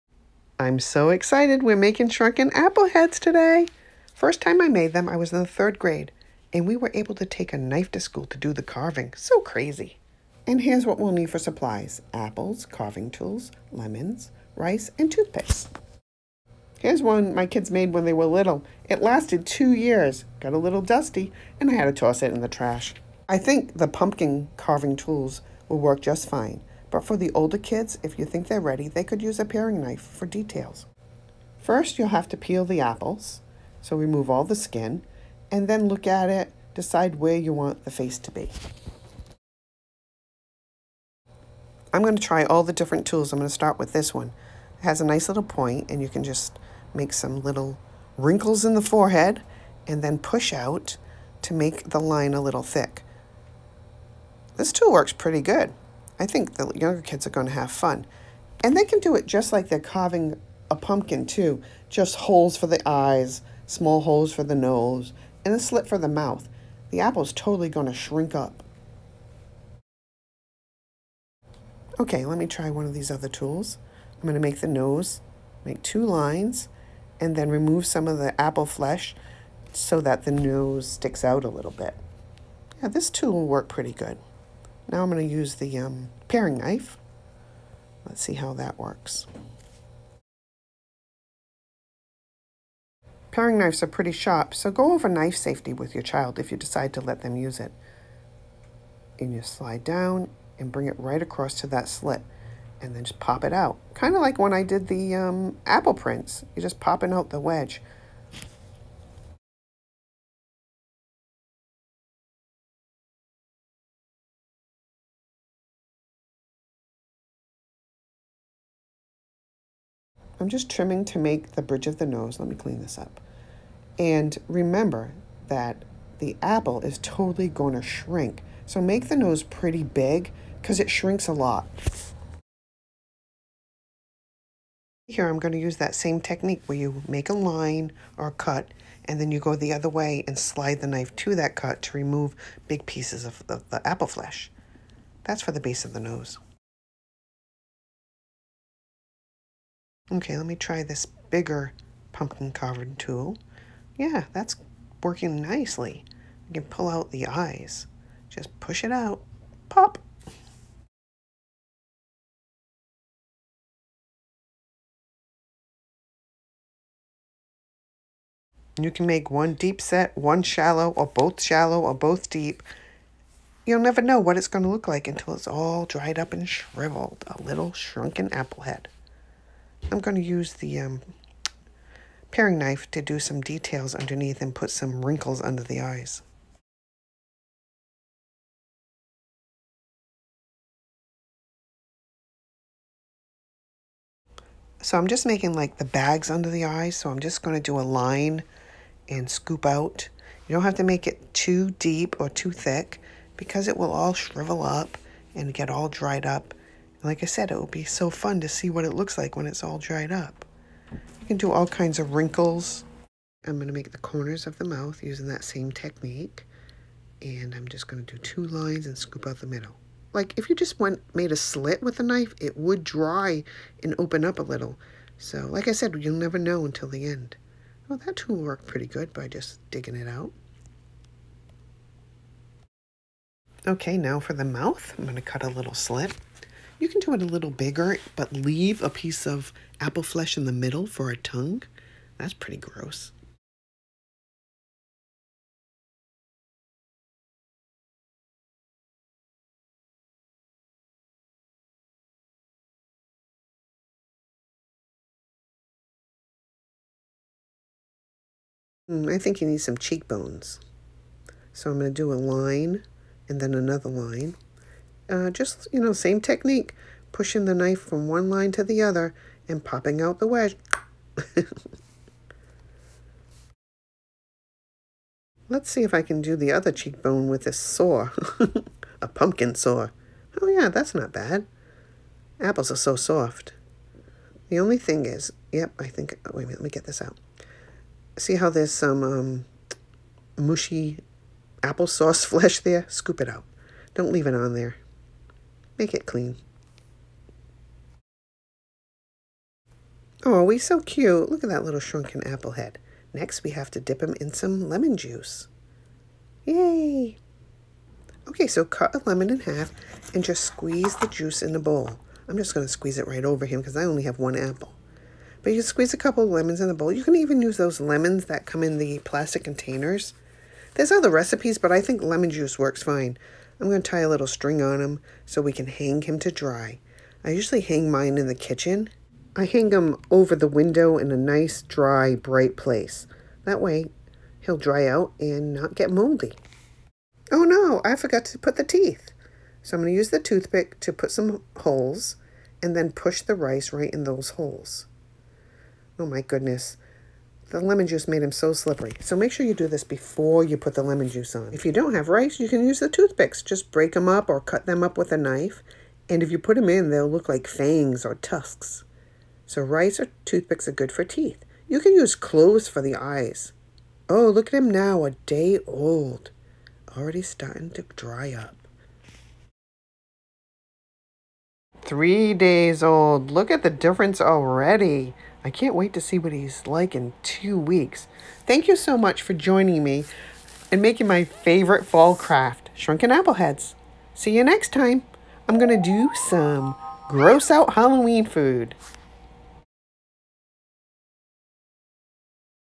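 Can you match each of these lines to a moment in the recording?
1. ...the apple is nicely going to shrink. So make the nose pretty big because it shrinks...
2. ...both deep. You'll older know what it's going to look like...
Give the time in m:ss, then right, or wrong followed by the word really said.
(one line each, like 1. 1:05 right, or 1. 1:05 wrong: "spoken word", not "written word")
1. 2:06 wrong: "totally", not "nicely"
2. 2:51 wrong: "never", not "older".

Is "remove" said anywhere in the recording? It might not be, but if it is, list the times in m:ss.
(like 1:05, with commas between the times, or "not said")
0:33, 1:17, 2:21.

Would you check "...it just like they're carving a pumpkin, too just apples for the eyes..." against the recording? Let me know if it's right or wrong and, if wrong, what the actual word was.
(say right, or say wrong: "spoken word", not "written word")
wrong: "holes", not "apples".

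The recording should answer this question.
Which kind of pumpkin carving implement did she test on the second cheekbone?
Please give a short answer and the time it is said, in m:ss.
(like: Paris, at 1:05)
a pumpkin saw, at 4:39.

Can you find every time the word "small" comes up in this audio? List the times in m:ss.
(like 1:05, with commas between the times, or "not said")
1:03.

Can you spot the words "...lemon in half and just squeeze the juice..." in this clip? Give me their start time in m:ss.
5:09.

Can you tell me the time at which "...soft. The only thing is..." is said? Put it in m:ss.
4:42.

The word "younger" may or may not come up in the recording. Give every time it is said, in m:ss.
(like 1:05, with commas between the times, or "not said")
0:56.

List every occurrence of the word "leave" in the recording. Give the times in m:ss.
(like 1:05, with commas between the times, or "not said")
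3:58, 4:54.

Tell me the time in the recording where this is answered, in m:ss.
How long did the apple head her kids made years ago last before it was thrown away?
0:19.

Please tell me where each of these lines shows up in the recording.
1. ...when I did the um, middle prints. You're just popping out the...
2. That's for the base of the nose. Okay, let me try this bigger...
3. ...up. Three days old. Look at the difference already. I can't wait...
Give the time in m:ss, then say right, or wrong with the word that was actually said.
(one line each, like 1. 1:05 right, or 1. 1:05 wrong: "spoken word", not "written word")
1. 1:44 wrong: "apple", not "middle"
2. 2:25 right
3. 6:08 right.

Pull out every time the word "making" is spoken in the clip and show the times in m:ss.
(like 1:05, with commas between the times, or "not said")
0:01, 3:15, 6:20.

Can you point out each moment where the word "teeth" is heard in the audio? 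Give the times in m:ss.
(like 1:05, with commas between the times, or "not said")
5:38, 6:01.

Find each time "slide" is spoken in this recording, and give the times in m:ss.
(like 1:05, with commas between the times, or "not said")
1:39, 2:20.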